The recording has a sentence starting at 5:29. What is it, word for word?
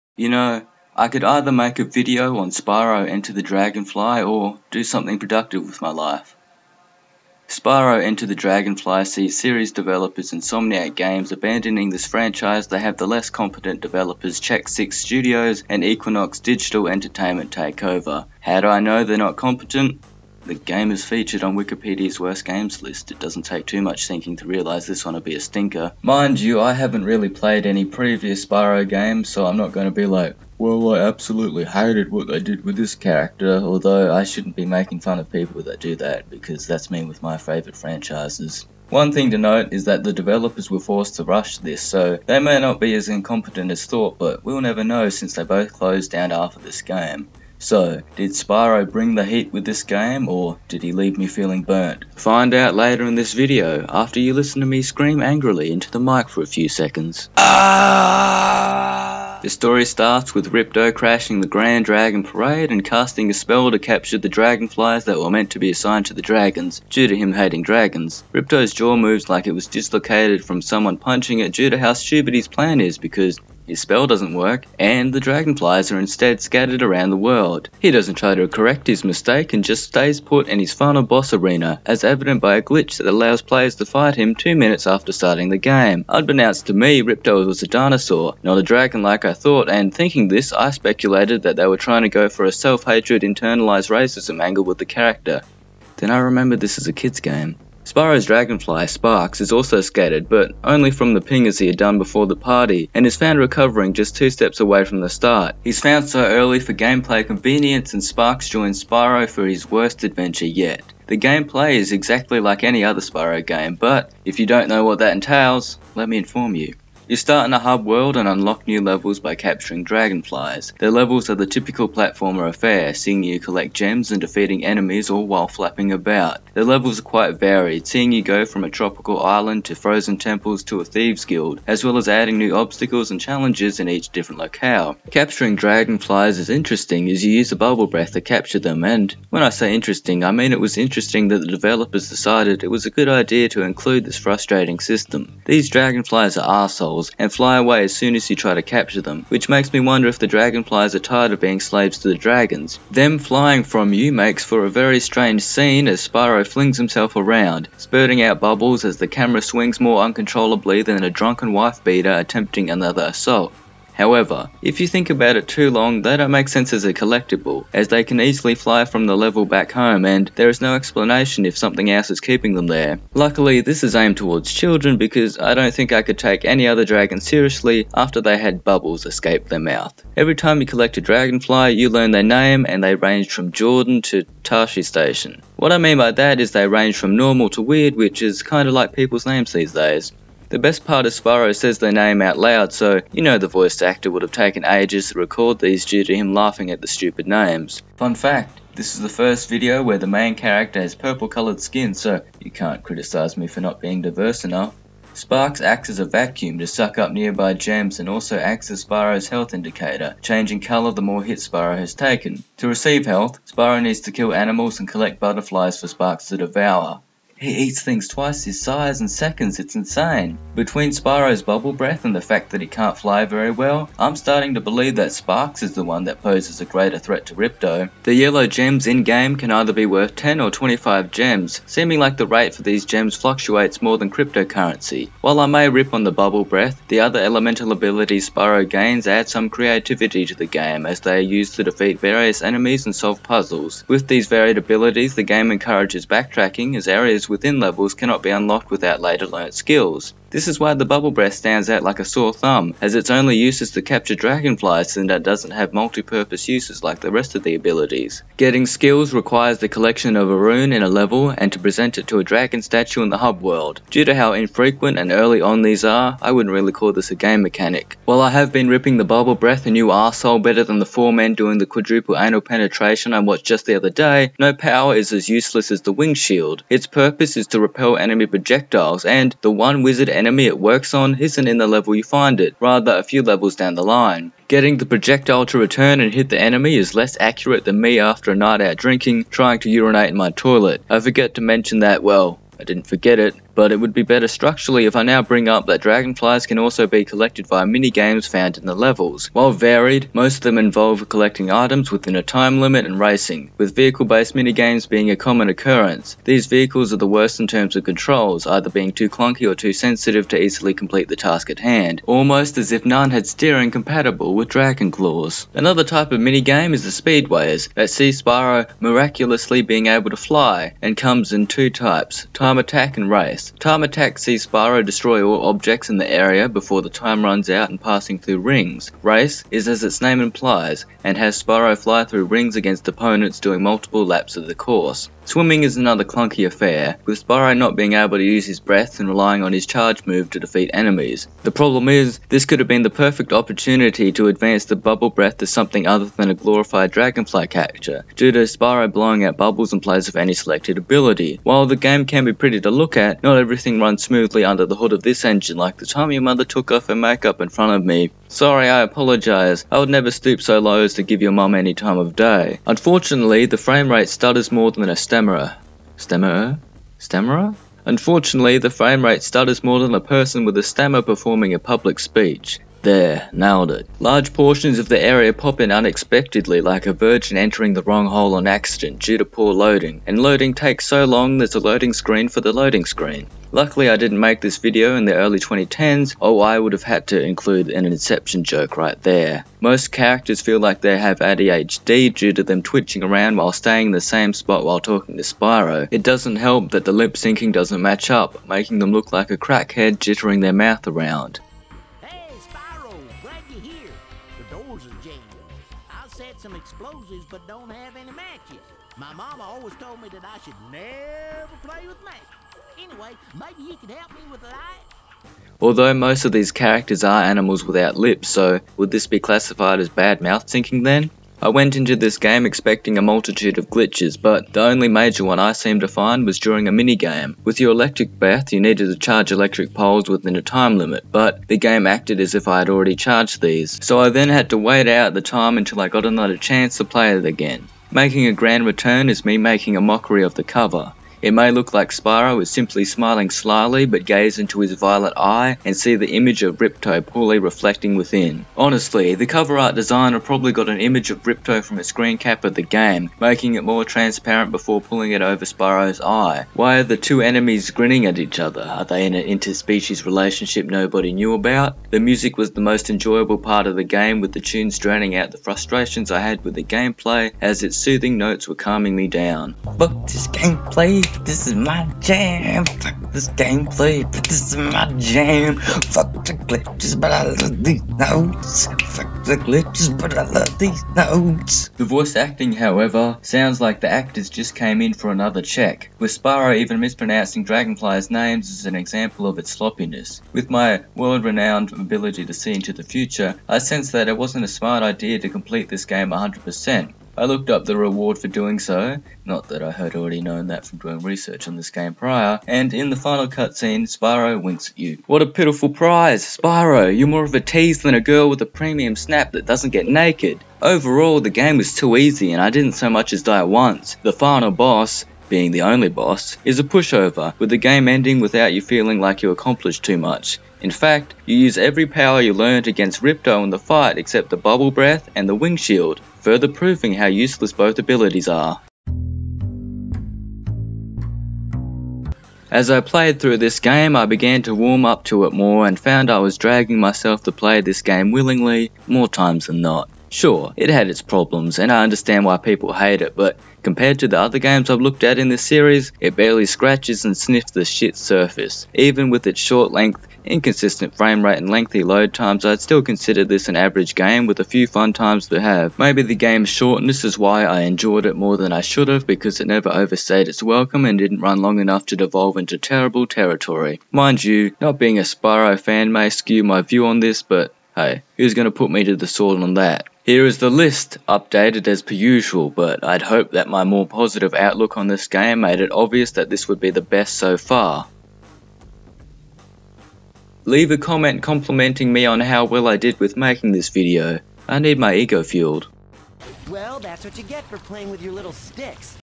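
Race is as its name implies, and has Spyro fly through rings against opponents doing multiple laps of the course.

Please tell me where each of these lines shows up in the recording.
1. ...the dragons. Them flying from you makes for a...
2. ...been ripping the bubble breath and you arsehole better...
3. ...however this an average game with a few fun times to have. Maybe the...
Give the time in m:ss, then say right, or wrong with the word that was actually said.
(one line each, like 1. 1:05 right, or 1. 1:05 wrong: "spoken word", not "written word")
1. 2:32 right
2. 4:28 right
3. 9:12 wrong: "consider", not "however".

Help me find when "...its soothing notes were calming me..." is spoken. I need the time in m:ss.
7:47.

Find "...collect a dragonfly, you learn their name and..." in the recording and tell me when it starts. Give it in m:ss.
3:00.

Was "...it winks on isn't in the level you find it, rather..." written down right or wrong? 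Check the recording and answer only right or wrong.
wrong.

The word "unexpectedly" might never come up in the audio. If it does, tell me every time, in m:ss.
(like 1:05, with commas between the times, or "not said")
6:15.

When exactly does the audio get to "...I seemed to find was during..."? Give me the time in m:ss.
7:05.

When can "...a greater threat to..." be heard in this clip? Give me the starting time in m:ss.
3:46.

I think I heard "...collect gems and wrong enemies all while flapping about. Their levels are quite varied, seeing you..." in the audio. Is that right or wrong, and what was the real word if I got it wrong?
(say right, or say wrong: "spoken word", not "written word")
wrong: "defeating", not "wrong".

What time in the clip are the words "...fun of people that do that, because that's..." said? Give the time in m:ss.
0:35.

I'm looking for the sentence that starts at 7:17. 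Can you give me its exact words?
Making a grand return is me making a mockery of the cover.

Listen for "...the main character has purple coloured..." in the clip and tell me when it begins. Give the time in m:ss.
3:19.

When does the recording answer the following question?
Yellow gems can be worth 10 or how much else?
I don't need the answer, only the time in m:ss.
3:50.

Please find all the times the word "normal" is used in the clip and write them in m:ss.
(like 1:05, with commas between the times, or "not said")
3:07.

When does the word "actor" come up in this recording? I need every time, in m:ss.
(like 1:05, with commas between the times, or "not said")
3:13, 8:03.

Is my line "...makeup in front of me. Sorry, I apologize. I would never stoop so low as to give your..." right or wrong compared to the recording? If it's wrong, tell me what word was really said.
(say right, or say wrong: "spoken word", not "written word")
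right.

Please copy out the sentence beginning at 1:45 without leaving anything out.
He's found so early for gameplay convenience, and Sparx joins Spyro for his worst adventure yet.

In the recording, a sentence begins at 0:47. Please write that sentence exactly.
So, did Spyro bring the heat with this game, or did he leave me feeling burnt?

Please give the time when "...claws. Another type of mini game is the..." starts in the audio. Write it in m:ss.
5:14.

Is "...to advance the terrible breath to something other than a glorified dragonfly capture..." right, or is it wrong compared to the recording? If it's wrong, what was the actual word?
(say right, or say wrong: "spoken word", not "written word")
wrong: "bubble", not "terrible".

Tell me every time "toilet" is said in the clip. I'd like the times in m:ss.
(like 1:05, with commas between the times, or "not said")
4:50.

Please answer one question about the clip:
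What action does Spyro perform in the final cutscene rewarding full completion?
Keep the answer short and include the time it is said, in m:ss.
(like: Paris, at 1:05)
Winks, at 8:24.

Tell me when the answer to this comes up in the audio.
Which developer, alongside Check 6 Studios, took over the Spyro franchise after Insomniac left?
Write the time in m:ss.
0:15.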